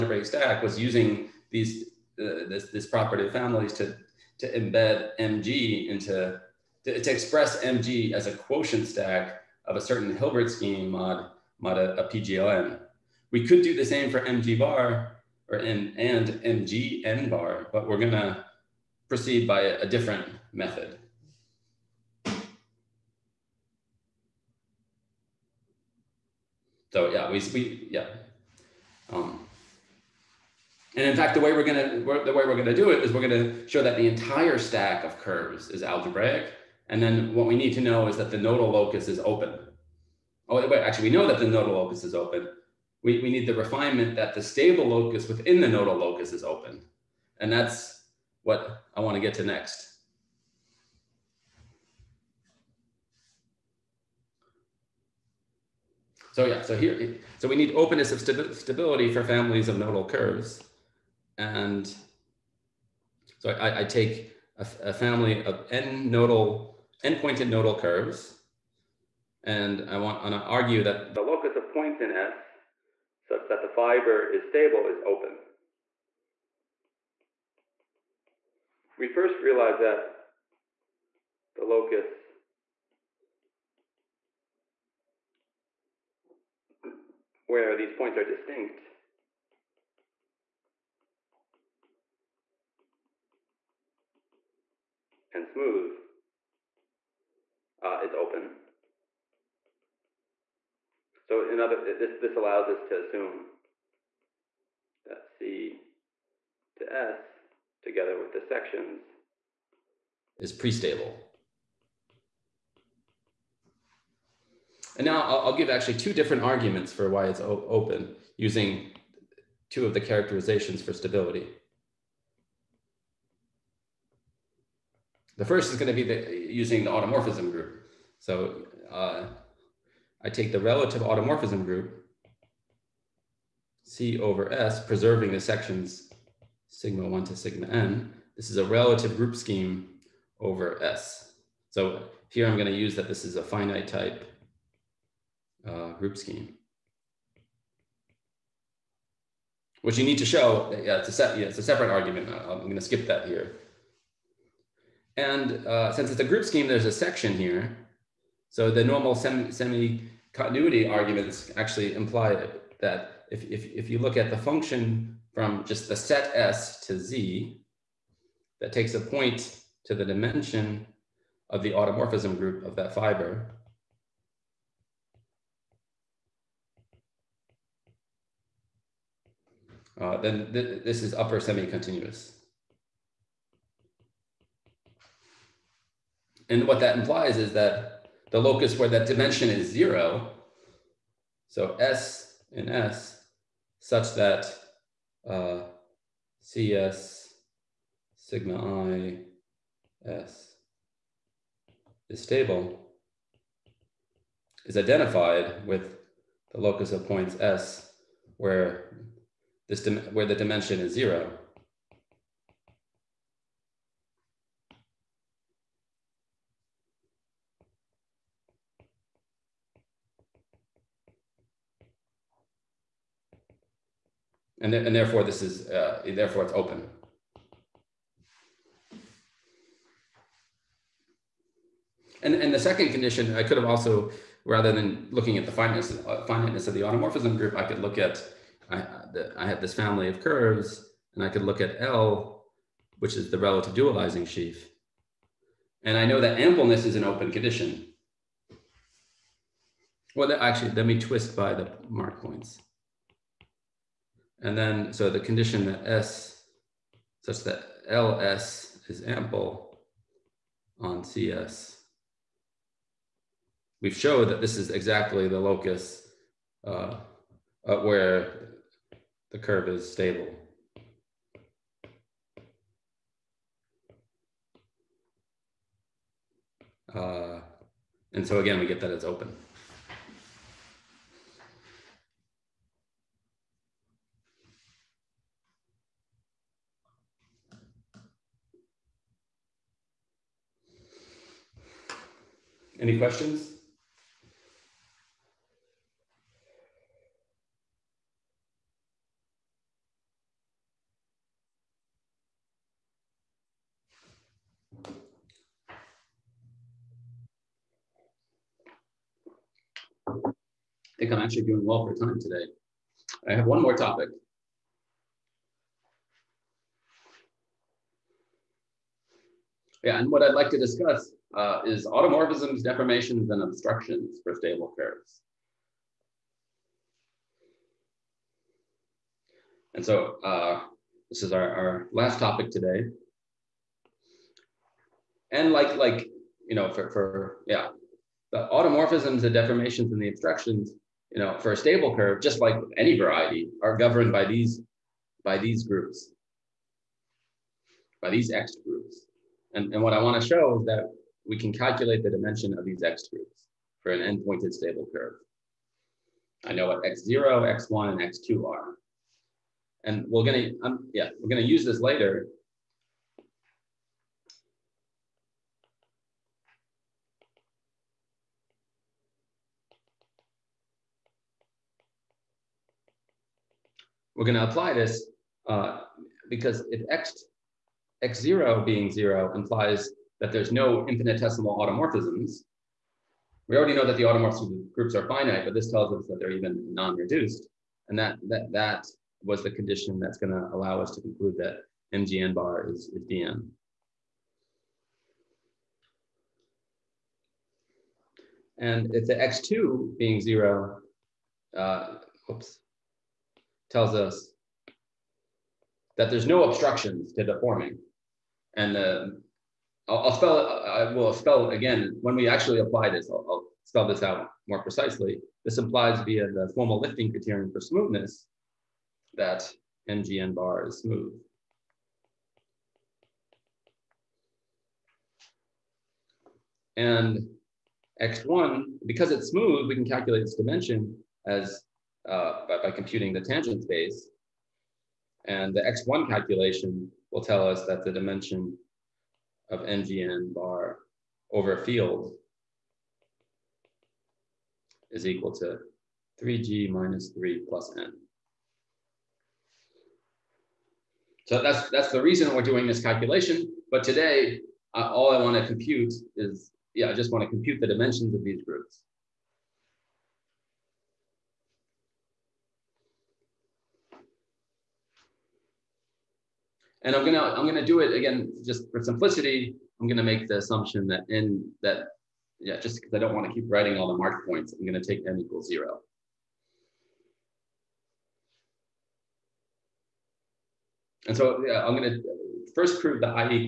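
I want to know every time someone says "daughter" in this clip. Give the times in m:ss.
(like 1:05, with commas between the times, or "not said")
not said.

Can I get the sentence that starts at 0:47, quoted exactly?
And that's what I want to get to next.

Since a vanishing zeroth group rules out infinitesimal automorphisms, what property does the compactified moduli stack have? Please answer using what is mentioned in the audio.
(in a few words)
DM.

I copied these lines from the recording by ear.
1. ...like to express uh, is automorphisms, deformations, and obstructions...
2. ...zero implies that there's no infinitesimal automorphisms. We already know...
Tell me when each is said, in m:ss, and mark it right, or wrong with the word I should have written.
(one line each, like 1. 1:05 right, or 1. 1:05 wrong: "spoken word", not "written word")
1. 5:20 wrong: "discuss", not "express"
2. 6:18 right.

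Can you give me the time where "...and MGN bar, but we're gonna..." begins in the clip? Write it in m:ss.
0:15.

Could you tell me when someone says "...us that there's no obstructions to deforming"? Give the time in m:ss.
6:43.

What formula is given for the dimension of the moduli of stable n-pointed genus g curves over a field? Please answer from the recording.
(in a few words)
3G minus 3 plus N.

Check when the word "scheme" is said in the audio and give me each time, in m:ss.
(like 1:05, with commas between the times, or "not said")
0:10, 2:19, 2:26, 2:36.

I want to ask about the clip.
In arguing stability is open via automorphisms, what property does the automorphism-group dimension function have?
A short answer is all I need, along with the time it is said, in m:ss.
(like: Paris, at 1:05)
upper semi-continuous, at 3:01.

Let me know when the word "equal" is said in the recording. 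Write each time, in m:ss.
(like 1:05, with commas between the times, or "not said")
7:25, 7:55.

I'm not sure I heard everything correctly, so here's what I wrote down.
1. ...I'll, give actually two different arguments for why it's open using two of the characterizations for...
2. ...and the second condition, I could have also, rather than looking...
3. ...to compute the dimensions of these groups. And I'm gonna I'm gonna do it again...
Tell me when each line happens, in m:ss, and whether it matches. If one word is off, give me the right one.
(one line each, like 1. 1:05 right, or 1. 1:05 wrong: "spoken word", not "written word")
1. 1:55 right
2. 3:52 right
3. 7:37 right.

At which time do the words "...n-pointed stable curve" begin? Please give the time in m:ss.
5:54.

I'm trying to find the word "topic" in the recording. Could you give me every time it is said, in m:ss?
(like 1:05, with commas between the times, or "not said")
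5:13, 5:32.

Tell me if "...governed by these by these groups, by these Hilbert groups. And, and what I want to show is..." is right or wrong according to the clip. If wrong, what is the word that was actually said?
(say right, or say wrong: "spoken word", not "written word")
wrong: "Ext", not "Hilbert".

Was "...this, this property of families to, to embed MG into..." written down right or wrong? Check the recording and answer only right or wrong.
right.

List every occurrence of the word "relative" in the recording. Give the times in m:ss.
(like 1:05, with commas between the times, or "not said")
2:10, 2:18, 4:03.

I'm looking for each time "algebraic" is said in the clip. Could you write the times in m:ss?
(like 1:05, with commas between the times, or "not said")
0:35.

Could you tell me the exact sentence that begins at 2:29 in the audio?
Which you need to show, yeah, it's a, yeah, it's a separate argument.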